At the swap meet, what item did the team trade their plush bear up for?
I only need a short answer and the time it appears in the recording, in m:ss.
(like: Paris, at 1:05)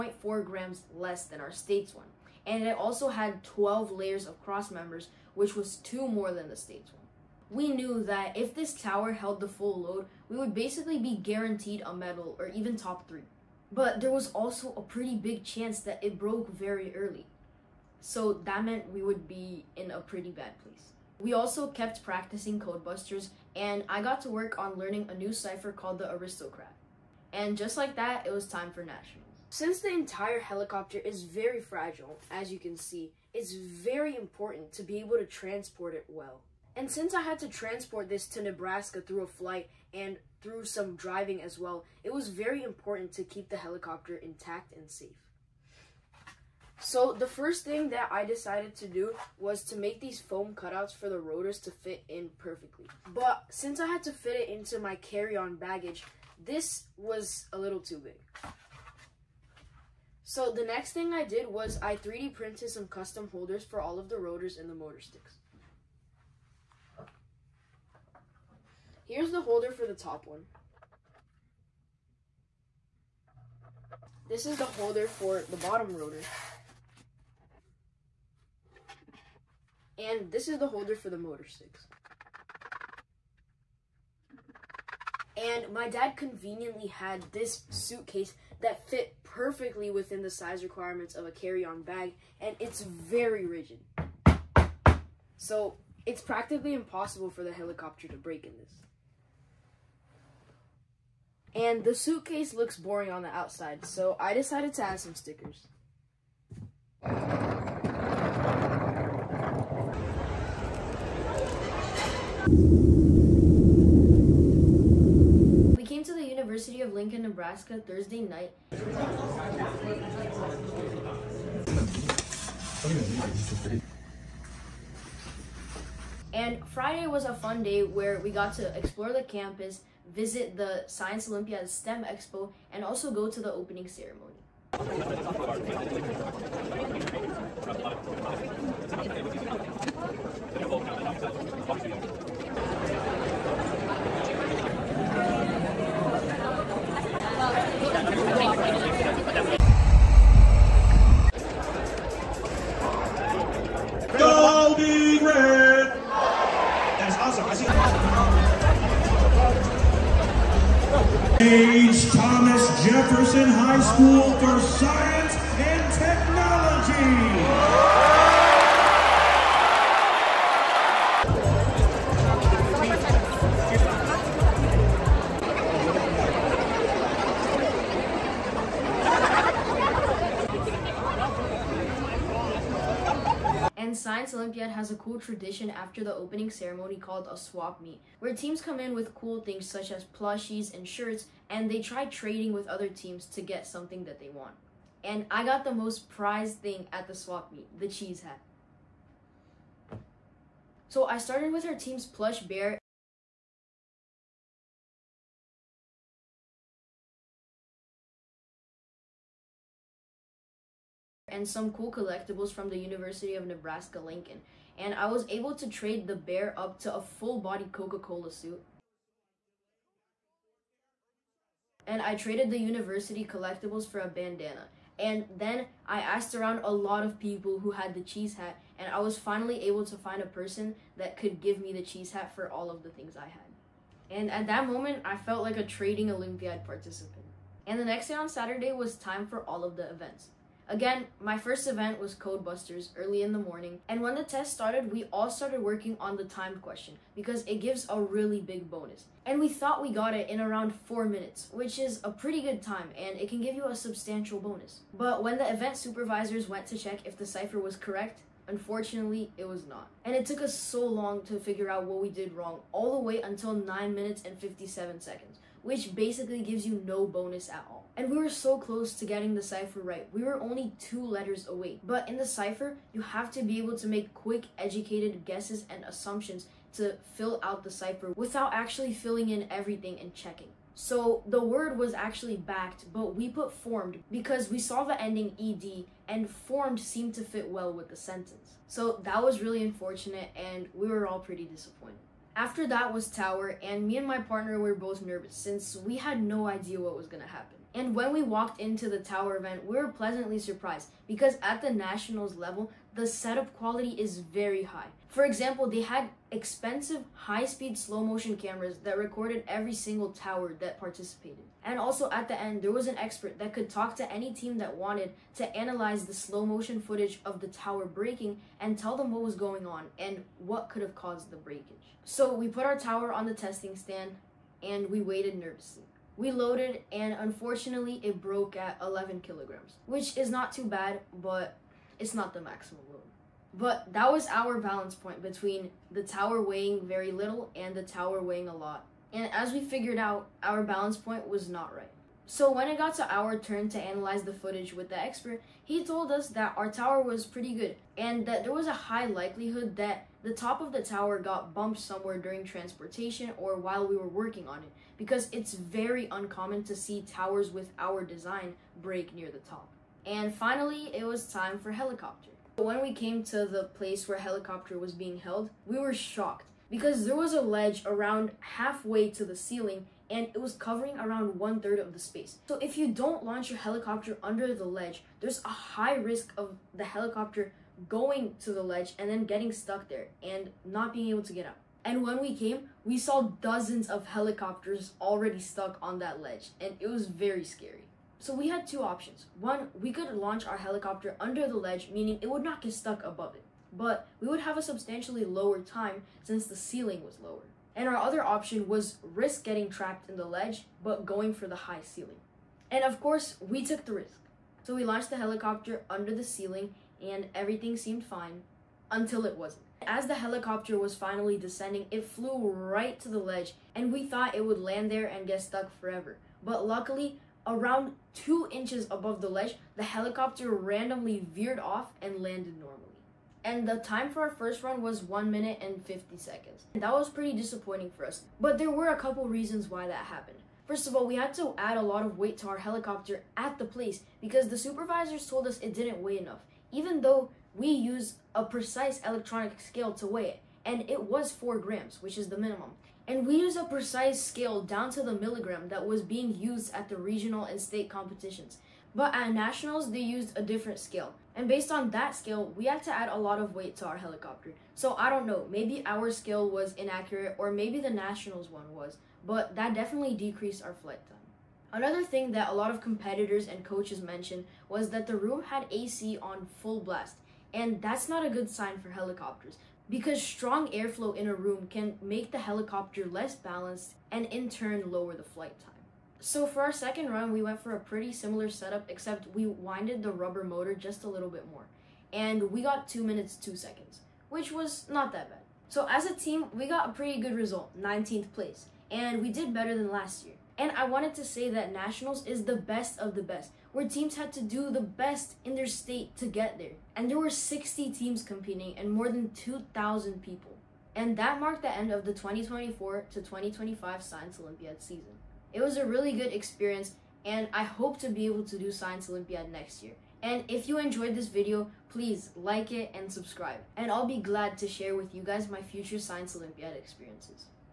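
Coca-Cola suit, at 3:37.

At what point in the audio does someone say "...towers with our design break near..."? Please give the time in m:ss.
5:57.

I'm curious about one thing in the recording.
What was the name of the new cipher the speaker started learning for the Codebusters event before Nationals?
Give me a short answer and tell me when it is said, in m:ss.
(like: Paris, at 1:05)
Aristocrat, at 0:26.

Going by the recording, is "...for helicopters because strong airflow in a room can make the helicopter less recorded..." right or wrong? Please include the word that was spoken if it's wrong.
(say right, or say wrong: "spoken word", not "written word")
wrong: "balanced", not "recorded".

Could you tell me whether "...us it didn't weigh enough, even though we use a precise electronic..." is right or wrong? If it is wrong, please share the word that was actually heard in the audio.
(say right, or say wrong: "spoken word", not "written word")
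right.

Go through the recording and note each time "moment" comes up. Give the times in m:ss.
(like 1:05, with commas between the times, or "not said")
3:54.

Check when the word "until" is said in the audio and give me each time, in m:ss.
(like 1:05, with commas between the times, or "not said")
4:23, 6:48.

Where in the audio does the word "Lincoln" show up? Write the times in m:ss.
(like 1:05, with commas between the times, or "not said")
1:56, 3:33.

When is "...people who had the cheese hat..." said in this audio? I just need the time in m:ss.
3:47.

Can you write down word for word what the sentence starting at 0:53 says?
But since I had to fit it into my carry-on baggage, this was a little too big.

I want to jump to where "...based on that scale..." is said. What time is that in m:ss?
7:31.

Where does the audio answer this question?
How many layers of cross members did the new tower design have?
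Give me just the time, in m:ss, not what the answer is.
0:03.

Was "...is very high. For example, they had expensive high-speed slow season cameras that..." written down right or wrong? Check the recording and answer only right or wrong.
wrong.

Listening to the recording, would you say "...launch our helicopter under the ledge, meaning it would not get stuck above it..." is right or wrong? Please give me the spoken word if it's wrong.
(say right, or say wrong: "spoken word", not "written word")
right.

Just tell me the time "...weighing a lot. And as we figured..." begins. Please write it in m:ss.
5:38.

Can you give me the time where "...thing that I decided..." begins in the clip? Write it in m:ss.
0:47.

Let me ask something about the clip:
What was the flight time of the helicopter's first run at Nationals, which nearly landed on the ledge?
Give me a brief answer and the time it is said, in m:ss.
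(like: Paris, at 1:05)
1 minute 50 seconds, at 7:05.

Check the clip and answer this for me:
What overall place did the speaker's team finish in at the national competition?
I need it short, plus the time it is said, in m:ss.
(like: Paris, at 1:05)
19th, at 8:07.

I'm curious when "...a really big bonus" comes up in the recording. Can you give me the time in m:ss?
4:07.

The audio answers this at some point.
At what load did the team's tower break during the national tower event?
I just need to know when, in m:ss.
5:28.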